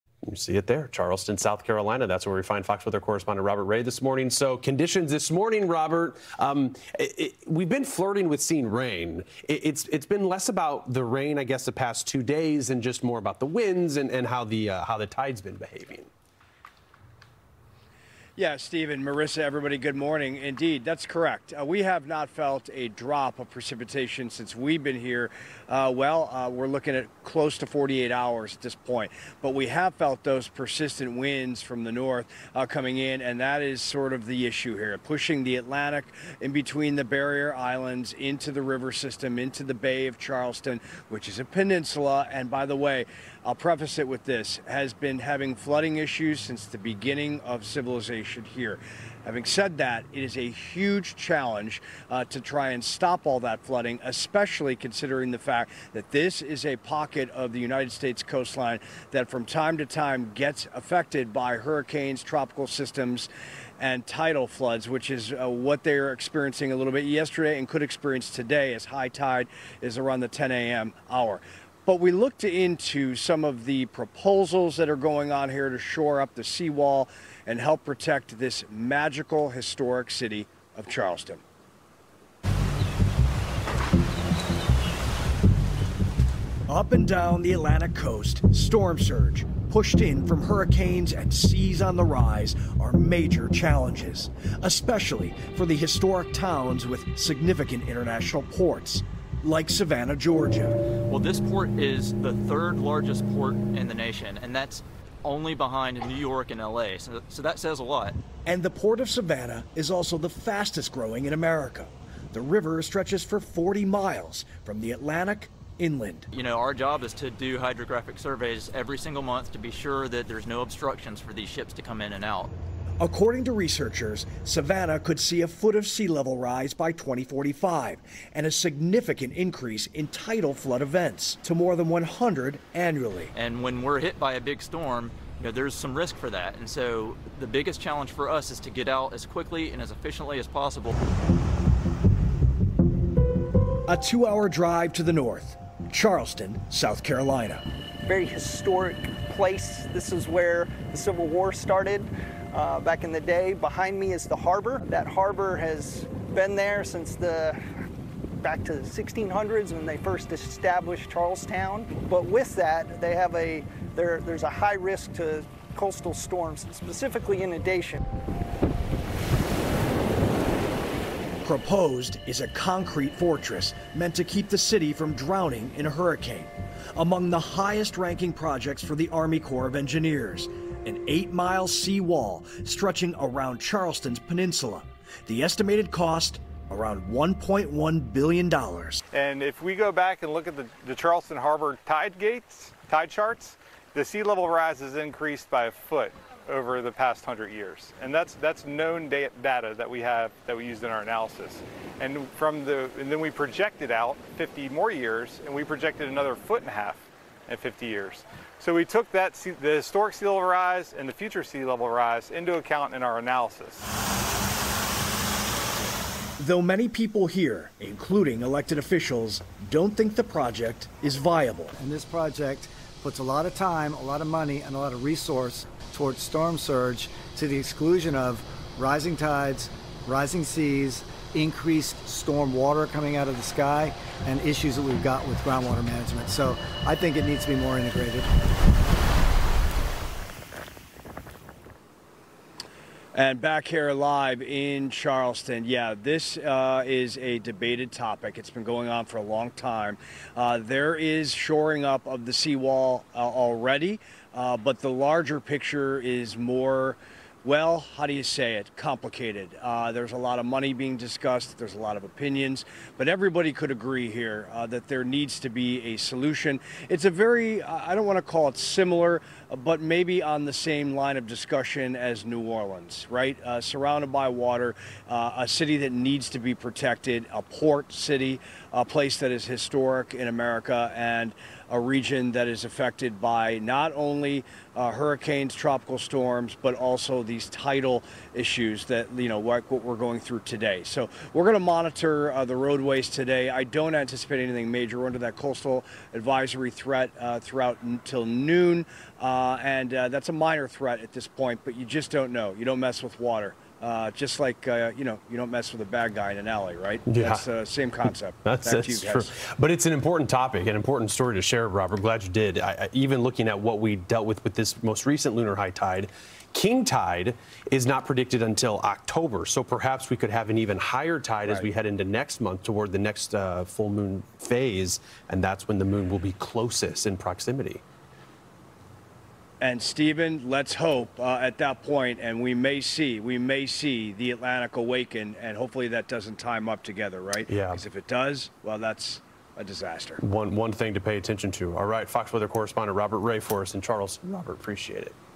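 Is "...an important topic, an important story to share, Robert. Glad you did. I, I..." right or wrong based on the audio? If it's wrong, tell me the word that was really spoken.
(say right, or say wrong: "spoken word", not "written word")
right.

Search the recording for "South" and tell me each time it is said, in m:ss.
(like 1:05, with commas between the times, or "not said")
0:01, 2:26.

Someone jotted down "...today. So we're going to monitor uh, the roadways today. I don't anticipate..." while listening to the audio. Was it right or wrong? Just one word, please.
right.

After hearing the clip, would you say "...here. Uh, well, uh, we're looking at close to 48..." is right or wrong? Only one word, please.
right.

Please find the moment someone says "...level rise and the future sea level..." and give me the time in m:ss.
3:30.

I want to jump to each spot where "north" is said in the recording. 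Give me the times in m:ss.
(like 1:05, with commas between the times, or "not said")
0:31, 2:25.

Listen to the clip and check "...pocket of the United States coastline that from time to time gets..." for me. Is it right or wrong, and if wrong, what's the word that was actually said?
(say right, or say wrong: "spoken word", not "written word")
right.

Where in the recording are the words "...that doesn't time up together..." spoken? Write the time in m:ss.
5:35.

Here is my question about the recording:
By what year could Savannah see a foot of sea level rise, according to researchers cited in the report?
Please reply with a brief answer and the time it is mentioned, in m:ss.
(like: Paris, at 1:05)
2045, at 2:06.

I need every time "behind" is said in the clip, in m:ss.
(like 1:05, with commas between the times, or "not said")
1:45, 2:33.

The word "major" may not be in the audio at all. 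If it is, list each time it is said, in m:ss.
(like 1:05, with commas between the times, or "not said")
1:32, 4:54.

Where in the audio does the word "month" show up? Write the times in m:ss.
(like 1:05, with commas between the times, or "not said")
1:59, 5:22.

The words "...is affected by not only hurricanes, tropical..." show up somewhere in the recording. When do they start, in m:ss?
4:42.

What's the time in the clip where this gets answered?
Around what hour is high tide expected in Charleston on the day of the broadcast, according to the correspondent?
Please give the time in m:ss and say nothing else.
1:10.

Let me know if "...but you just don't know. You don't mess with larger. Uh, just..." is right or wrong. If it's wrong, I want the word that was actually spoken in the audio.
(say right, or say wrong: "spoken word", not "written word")
wrong: "water", not "larger".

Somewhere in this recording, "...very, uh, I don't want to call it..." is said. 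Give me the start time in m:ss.
4:27.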